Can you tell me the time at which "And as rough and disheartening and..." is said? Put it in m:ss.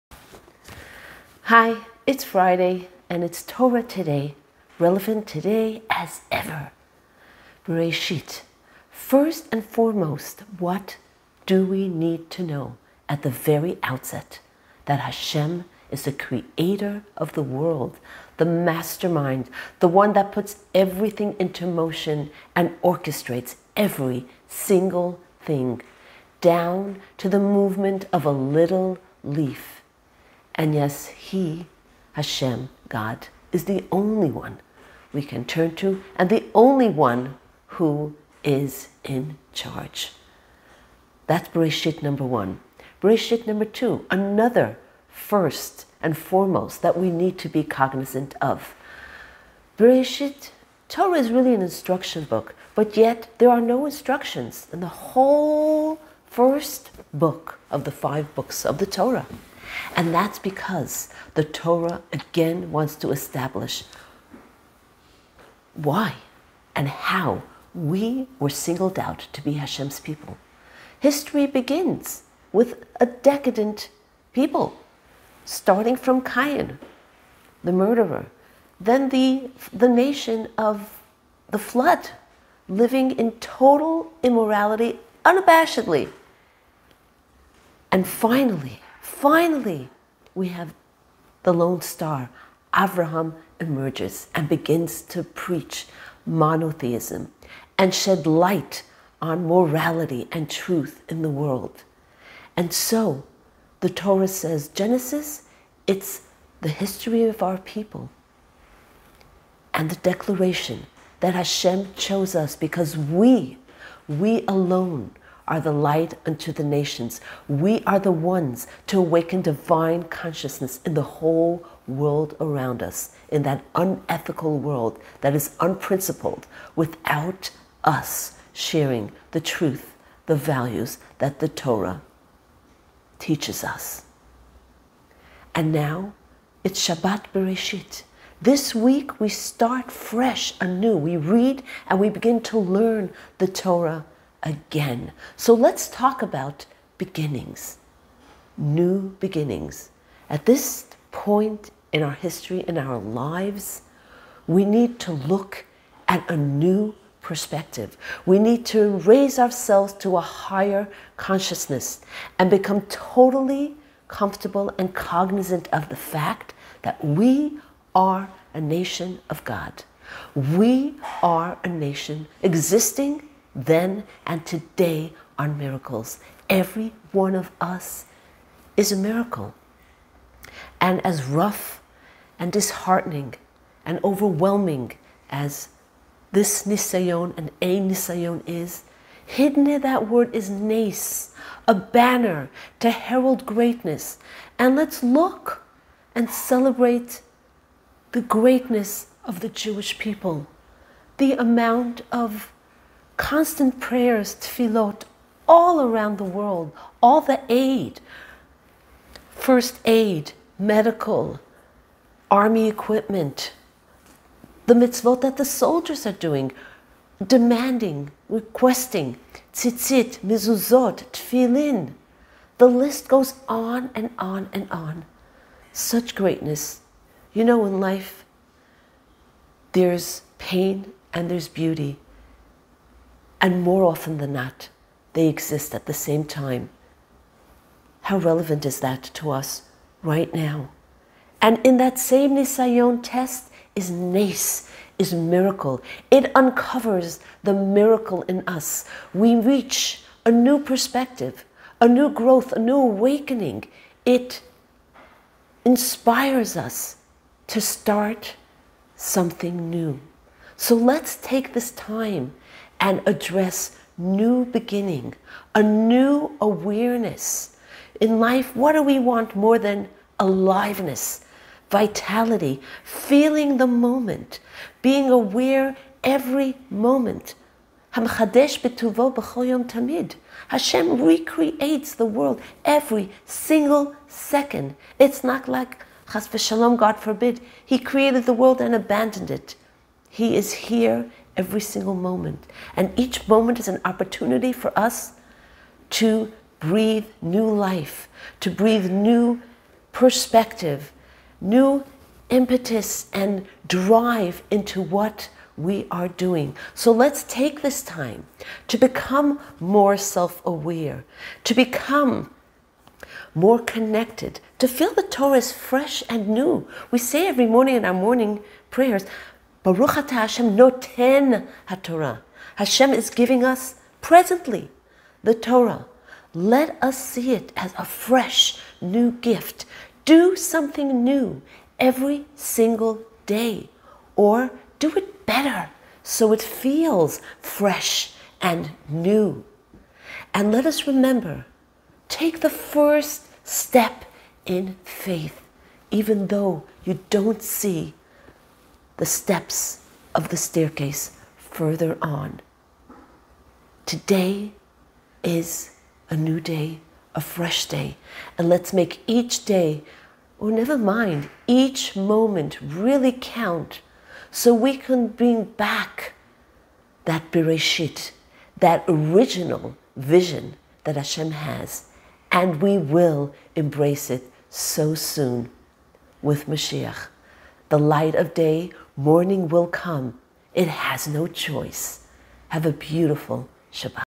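3:00.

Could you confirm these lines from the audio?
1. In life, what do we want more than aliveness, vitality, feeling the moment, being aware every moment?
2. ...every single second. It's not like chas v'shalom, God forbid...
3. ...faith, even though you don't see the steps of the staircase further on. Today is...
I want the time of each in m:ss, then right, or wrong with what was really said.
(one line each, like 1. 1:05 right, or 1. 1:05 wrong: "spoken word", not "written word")
1. 4:28 right
2. 4:42 right
3. 5:44 right.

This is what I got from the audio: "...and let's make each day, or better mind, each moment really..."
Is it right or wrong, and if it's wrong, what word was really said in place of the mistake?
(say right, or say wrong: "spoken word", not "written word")
wrong: "never", not "better".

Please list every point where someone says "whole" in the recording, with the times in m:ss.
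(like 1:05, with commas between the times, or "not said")
0:54, 2:01.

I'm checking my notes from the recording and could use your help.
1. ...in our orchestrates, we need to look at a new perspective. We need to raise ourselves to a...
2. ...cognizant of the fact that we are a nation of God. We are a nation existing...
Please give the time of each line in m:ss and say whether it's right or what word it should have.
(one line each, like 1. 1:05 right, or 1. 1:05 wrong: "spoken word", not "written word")
1. 2:32 wrong: "lives", not "orchestrates"
2. 2:44 right.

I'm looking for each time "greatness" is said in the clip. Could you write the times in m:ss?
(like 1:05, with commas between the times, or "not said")
3:13, 3:18, 3:46.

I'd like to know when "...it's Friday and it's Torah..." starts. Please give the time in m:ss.
0:02.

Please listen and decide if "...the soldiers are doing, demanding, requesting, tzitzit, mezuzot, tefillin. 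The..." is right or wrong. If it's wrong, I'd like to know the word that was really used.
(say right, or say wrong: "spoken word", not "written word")
right.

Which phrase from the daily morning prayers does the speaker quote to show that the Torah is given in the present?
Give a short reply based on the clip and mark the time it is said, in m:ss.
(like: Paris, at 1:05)
Baruch Ata Hashem noten HaTorah, at 5:19.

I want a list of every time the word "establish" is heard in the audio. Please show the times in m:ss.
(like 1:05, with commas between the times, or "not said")
1:03.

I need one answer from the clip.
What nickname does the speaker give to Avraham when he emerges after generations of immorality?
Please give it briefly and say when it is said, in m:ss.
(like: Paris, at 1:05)
The Lone Star, at 1:31.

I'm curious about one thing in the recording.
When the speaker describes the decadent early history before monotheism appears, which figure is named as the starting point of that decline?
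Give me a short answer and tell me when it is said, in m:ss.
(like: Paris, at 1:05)
Cain, at 1:16.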